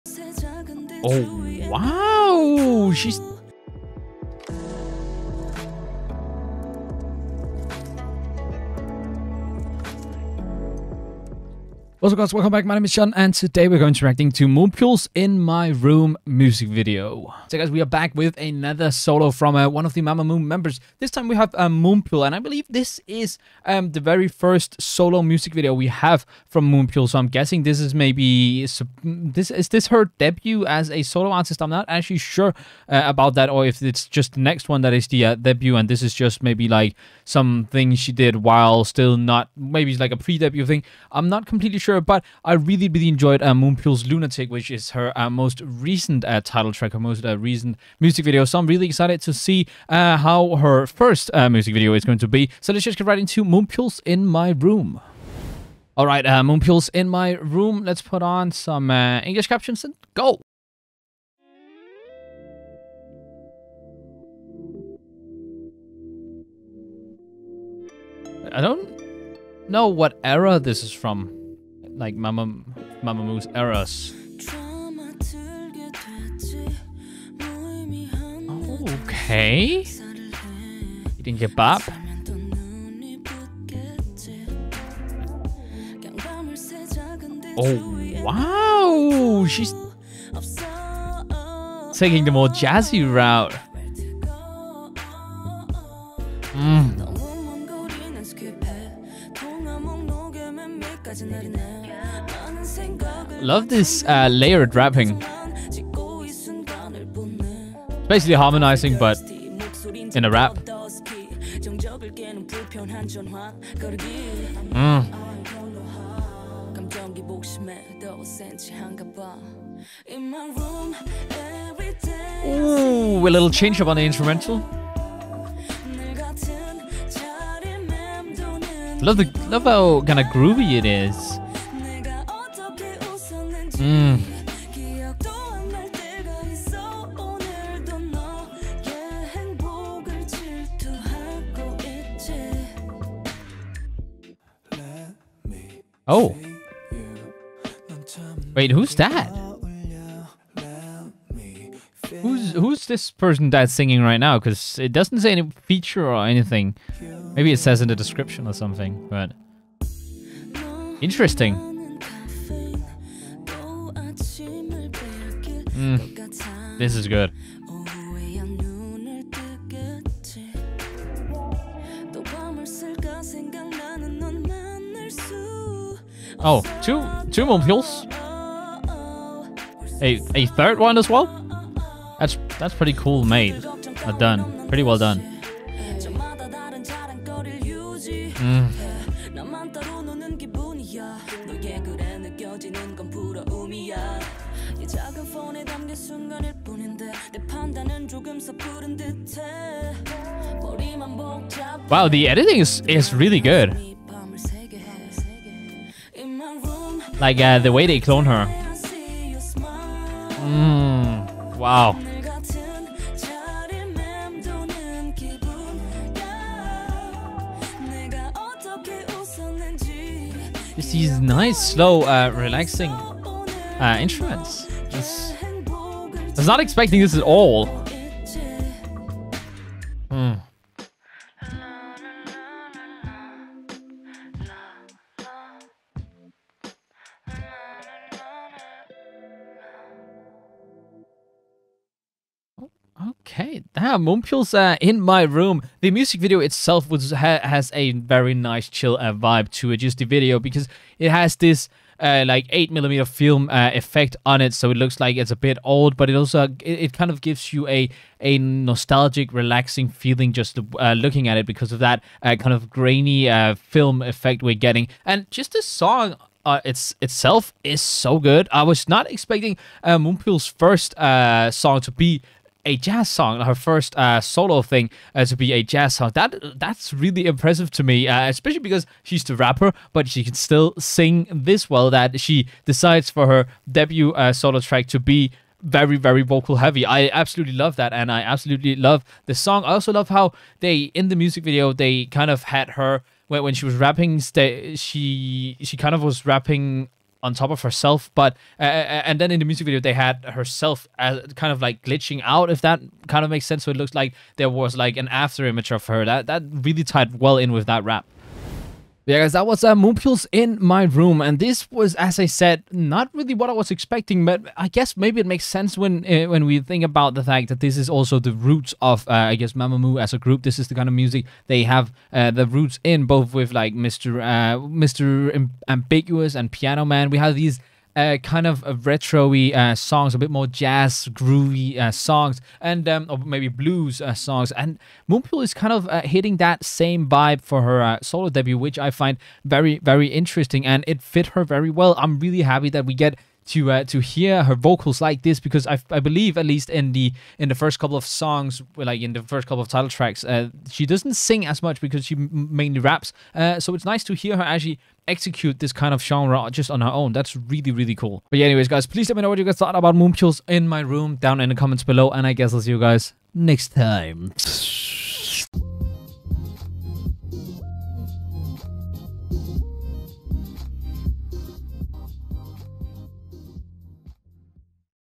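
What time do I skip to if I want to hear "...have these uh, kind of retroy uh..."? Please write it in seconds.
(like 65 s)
327 s.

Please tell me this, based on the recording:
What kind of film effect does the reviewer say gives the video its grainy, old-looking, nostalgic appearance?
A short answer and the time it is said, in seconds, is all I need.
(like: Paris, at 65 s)
8mm film, at 252 s.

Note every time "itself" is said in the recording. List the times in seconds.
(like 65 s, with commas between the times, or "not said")
246 s, 267 s.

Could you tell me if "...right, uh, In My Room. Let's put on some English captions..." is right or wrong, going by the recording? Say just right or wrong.
right.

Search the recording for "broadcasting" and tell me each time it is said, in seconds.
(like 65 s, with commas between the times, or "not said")
not said.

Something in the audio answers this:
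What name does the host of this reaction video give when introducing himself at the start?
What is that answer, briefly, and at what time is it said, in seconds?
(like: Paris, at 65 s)
Shun, at 12 s.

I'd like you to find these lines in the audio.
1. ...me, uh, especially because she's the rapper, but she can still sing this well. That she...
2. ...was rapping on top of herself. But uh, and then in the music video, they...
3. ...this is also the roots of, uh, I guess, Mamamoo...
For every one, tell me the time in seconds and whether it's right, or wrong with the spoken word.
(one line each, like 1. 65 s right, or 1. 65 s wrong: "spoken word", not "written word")
1. 277 s right
2. 296 s right
3. 317 s right.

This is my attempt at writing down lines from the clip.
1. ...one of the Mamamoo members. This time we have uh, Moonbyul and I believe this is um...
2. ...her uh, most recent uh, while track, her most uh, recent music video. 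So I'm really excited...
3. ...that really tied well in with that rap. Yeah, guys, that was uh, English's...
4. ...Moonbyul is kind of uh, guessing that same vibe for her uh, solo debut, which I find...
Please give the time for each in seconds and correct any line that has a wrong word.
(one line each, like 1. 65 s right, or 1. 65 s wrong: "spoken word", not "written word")
1. 19 s right
2. 44 s wrong: "title", not "while"
3. 306 s wrong: "Moonbyul", not "English"
4. 335 s wrong: "hitting", not "guessing".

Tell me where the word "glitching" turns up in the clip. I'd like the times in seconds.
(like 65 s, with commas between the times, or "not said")
301 s.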